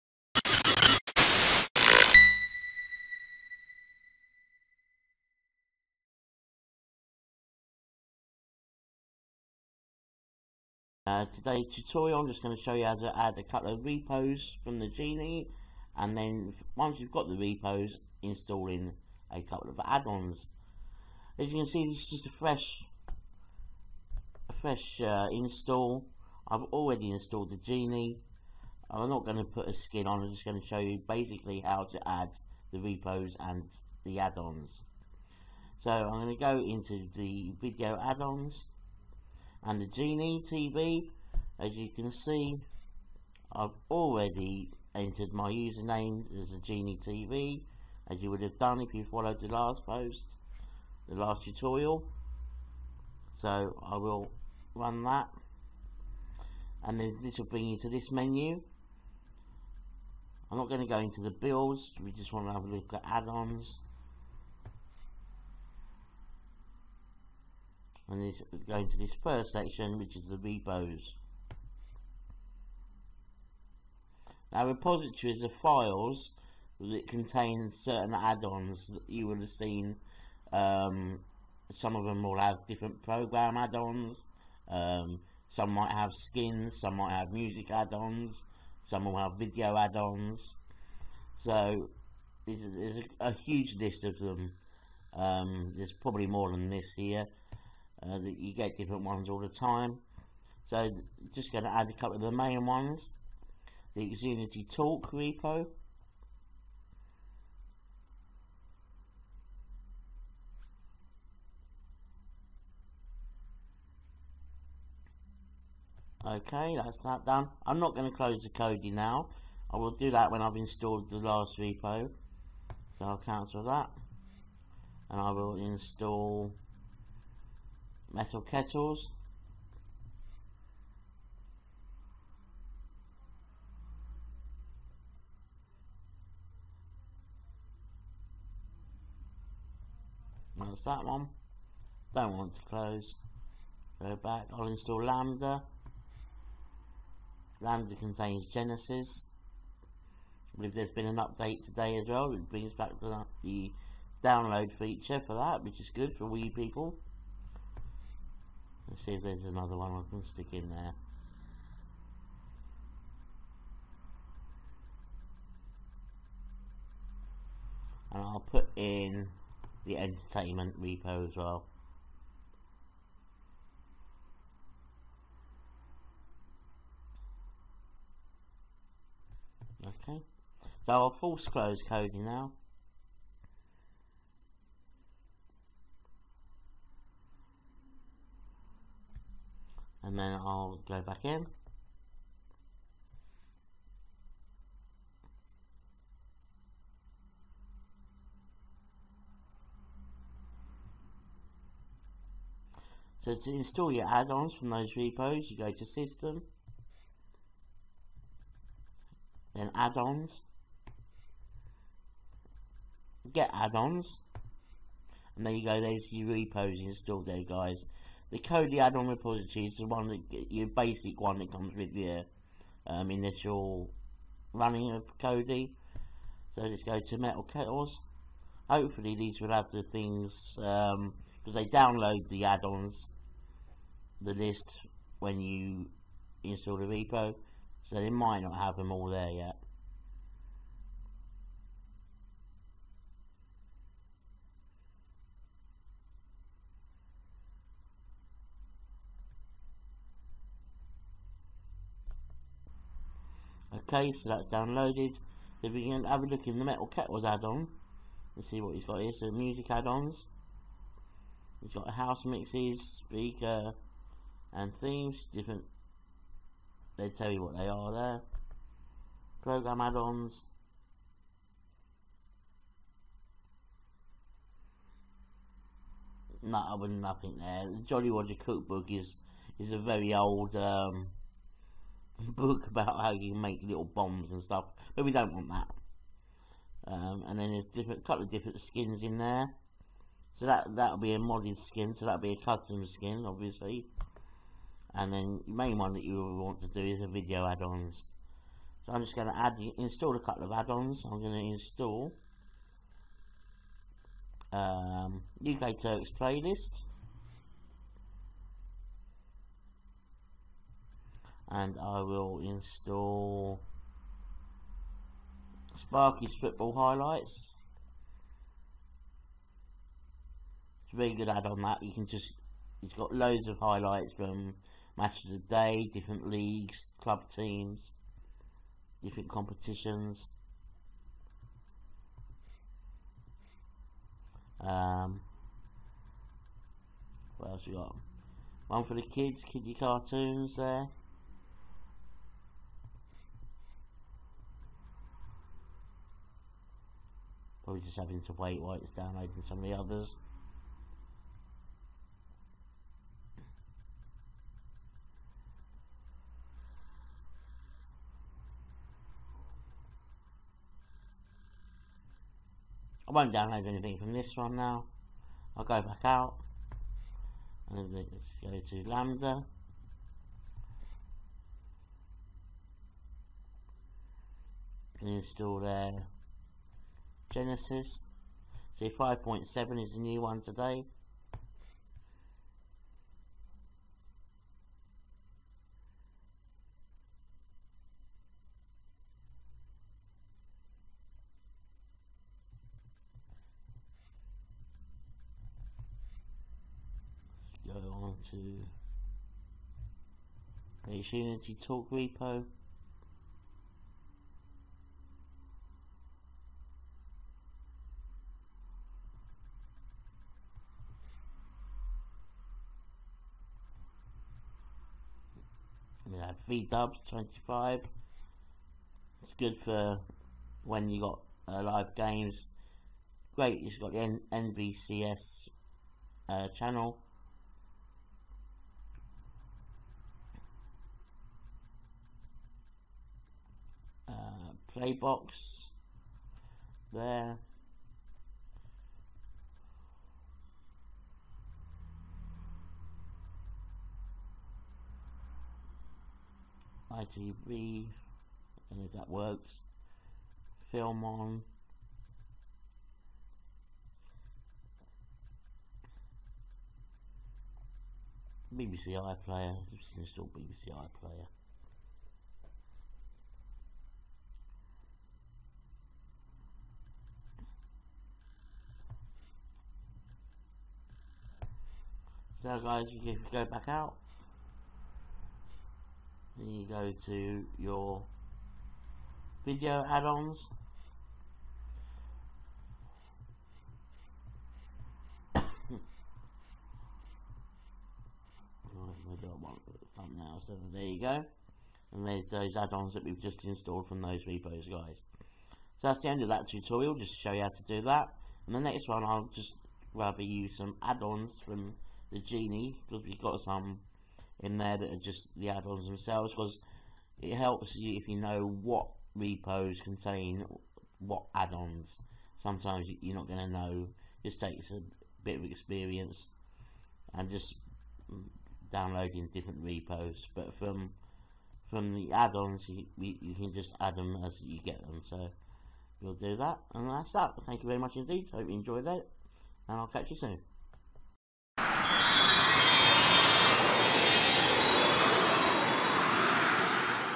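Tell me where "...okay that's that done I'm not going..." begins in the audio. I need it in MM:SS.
01:56.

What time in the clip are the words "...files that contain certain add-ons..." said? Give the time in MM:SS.
01:15.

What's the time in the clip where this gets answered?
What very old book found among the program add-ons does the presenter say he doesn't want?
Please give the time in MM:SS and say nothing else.
04:37.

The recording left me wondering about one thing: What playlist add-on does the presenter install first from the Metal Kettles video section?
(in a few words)
UK Turks playlist.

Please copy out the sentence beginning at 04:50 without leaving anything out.
So that that'll be a modded skin, so that'll be a custom skin, obviously.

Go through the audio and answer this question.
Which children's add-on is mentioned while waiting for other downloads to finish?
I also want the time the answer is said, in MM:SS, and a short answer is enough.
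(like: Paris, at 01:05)
kiddie cartoons, at 05:39.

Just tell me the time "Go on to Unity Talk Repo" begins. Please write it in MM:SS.
06:37.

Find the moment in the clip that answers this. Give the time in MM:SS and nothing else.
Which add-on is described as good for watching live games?
06:56.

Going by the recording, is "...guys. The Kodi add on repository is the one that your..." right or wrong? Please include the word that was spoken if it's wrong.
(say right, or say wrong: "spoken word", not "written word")
right.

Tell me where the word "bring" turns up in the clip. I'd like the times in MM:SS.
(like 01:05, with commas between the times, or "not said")
00:57, 02:32.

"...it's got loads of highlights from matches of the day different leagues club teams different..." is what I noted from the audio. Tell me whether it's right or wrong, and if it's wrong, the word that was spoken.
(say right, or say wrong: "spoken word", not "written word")
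right.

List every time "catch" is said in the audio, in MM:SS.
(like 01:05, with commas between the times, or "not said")
08:49.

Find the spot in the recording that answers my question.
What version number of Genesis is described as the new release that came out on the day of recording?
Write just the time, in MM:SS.
06:18.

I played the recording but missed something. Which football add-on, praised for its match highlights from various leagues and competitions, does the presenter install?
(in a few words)
Sparky's football highlights.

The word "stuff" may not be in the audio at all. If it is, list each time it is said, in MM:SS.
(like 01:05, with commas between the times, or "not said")
04:44.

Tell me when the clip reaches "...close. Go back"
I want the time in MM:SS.
02:22.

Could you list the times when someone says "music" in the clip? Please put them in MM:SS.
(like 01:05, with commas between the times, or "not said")
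01:27, 04:19.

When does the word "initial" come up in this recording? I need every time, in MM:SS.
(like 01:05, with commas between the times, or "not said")
03:43.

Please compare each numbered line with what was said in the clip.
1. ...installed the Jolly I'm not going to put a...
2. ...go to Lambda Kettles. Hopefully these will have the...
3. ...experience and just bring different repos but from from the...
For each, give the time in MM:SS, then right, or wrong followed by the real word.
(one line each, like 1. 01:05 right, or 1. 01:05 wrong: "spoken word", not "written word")
1. 00:27 wrong: "Genie", not "Jolly"
2. 03:46 wrong: "Metal", not "Lambda"
3. 08:35 wrong: "downloading", not "bring".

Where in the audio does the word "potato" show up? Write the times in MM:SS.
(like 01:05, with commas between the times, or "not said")
not said.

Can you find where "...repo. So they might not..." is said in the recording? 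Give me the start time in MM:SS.
03:56.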